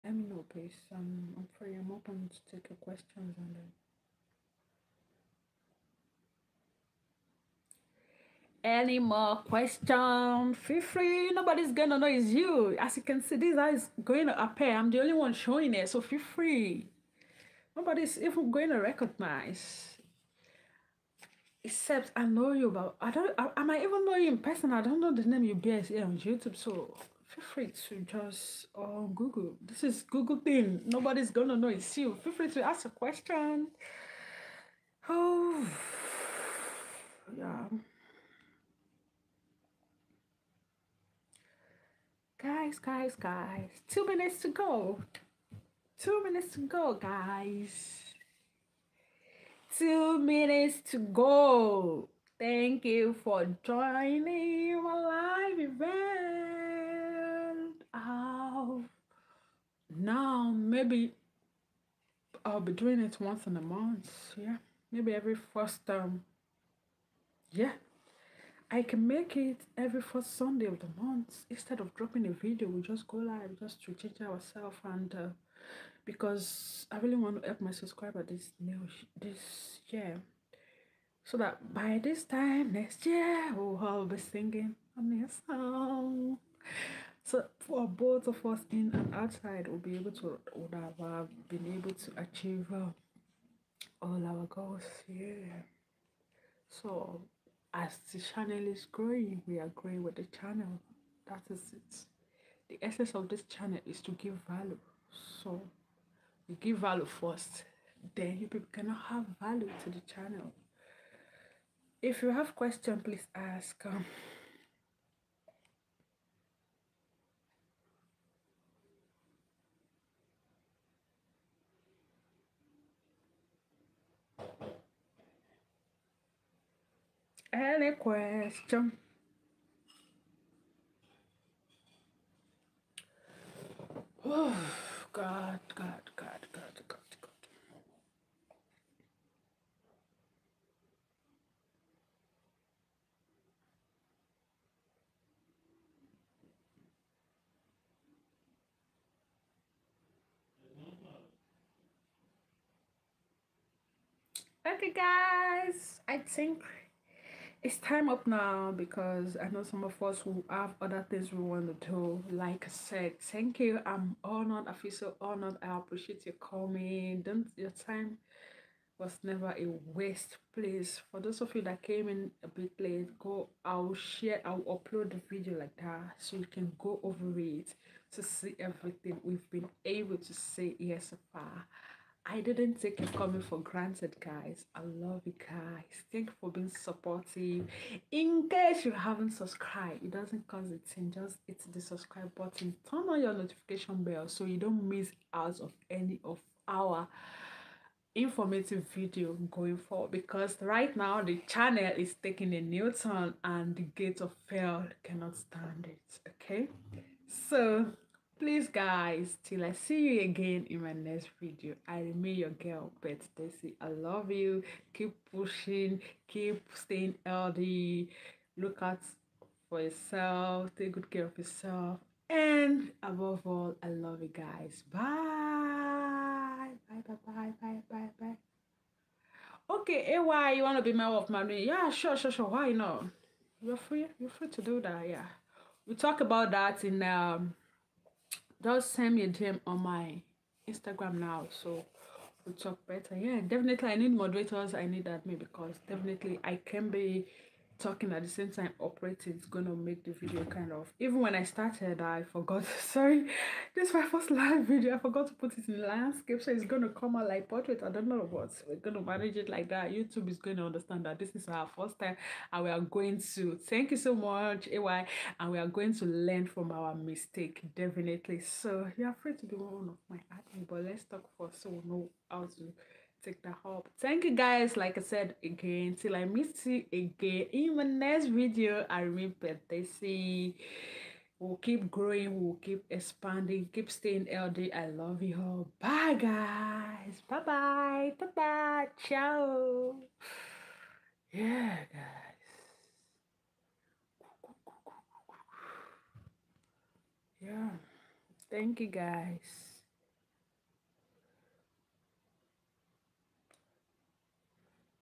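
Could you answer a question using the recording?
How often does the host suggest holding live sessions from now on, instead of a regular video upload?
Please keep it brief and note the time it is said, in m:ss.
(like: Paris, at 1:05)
Every first Sunday of the month, at 1:09.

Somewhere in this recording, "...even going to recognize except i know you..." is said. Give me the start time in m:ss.
0:18.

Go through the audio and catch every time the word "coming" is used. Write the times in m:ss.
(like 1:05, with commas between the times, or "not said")
2:46, 3:03.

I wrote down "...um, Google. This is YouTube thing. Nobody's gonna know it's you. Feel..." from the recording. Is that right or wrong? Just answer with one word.
wrong.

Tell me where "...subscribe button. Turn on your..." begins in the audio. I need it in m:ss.
3:11.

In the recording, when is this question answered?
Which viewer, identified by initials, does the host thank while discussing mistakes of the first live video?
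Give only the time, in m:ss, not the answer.
4:24.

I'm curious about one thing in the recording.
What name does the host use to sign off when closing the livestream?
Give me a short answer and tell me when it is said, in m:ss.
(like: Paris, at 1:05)
Pet Dessy, at 3:32.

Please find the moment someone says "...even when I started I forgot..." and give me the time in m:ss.
4:10.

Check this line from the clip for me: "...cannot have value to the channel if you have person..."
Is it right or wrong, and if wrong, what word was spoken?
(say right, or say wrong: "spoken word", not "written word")
wrong: "question", not "person".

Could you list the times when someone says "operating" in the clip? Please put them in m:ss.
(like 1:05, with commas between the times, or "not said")
4:08.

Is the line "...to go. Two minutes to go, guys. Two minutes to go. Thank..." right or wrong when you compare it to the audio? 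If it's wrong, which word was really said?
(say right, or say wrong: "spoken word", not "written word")
right.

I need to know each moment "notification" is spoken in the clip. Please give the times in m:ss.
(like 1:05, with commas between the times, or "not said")
3:13.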